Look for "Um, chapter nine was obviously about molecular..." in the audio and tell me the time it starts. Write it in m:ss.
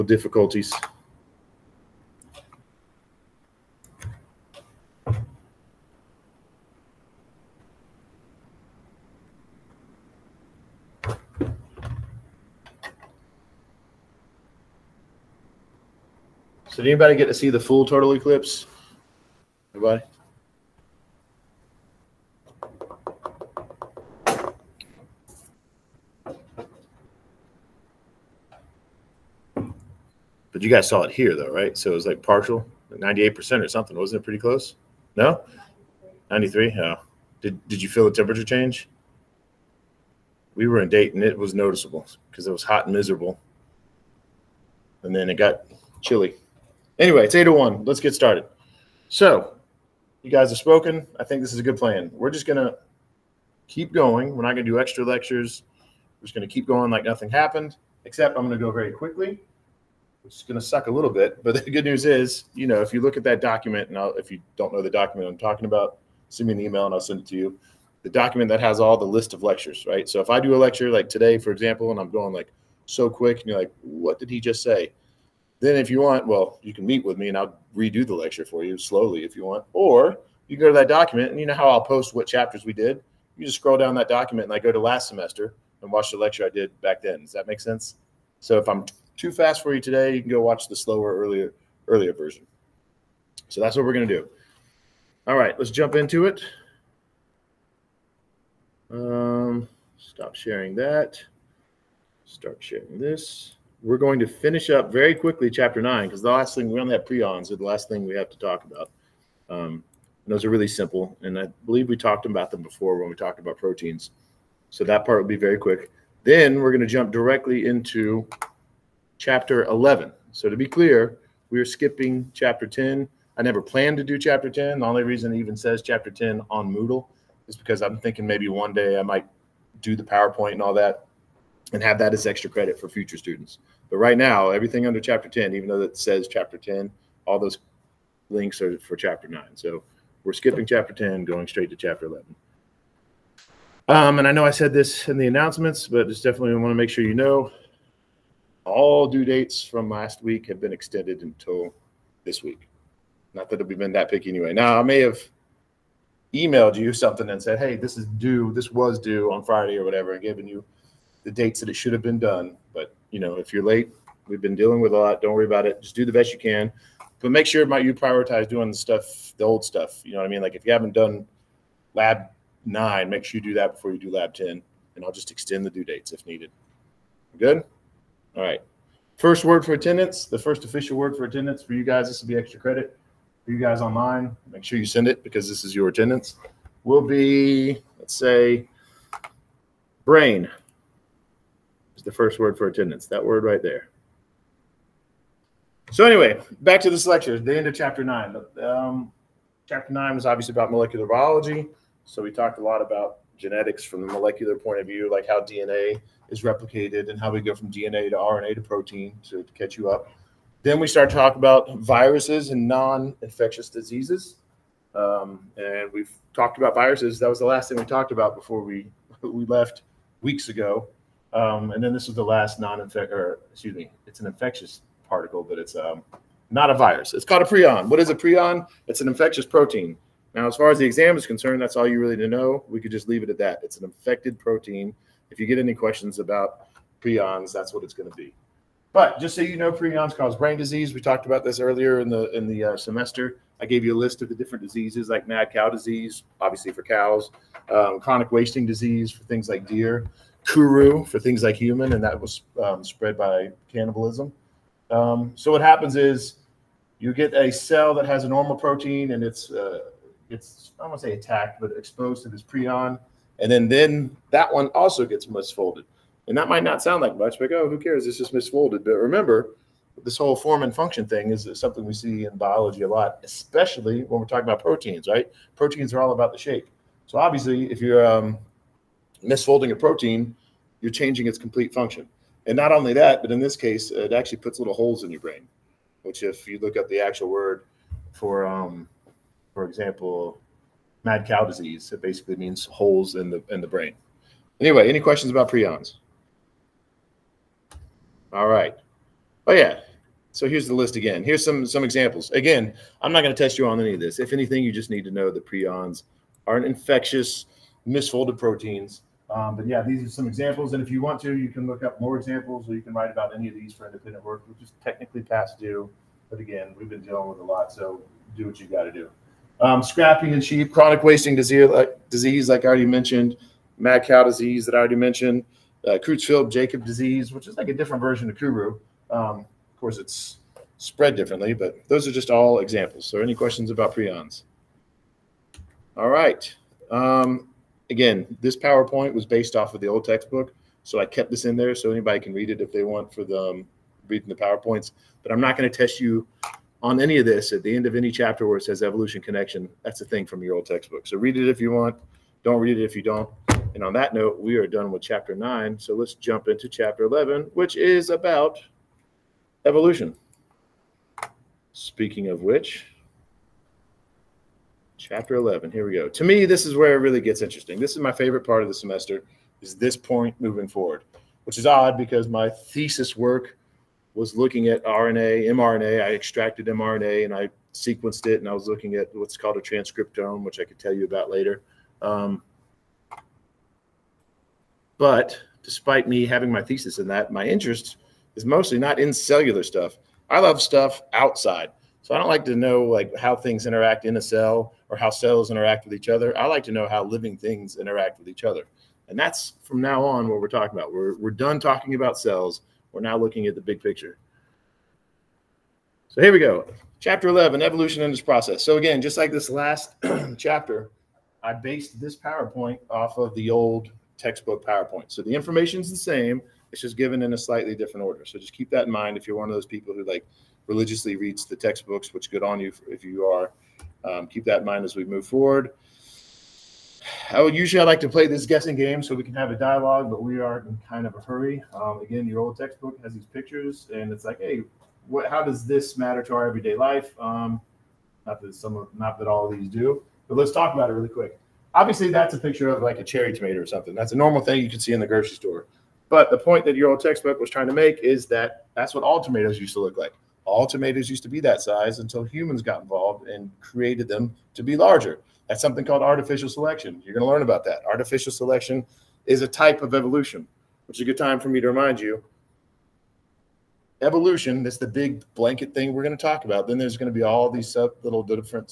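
3:18.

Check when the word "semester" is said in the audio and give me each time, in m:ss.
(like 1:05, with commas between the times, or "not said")
1:25, 4:02, 6:08.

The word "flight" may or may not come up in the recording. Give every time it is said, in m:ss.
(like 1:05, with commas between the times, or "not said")
not said.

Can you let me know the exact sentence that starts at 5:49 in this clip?
That's a thing from your old textbook.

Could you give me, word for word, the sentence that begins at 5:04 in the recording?
If anything, you just need to know that prions are infectious misfolded proteins um, but yeah, these are some examples.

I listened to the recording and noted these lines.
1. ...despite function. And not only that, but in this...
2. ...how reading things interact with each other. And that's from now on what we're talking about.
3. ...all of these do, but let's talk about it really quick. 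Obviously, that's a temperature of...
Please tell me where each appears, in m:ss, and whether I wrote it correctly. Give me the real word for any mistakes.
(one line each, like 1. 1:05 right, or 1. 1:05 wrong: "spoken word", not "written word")
1. 4:41 wrong: "complete", not "despite"
2. 6:36 wrong: "living", not "reading"
3. 7:19 wrong: "picture", not "temperature".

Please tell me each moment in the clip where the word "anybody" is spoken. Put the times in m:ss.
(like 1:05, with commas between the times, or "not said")
0:16, 5:41.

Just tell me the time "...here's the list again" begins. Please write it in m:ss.
5:00.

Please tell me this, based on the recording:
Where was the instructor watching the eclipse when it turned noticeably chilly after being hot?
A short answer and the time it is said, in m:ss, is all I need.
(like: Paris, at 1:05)
Dayton, at 0:40.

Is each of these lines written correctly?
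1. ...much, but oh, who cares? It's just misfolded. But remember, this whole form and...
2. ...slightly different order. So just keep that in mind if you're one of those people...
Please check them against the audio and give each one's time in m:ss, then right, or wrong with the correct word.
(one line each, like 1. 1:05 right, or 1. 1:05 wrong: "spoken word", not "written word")
1. 4:27 right
2. 6:57 right.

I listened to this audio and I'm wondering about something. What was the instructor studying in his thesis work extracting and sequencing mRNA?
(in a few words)
transcriptome.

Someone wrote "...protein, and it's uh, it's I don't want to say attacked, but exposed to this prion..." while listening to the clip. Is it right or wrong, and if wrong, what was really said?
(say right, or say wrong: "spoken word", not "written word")
right.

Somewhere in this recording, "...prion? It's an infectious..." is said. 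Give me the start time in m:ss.
3:48.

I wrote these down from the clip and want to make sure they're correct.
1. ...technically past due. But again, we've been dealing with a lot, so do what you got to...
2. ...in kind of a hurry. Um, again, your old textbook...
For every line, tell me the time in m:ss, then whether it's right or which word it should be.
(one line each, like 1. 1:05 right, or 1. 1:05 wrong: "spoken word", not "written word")
1. 5:14 right
2. 7:10 right.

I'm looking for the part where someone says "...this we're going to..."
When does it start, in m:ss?
1:42.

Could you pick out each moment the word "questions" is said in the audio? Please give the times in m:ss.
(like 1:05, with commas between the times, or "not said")
3:55, 4:55, 5:33.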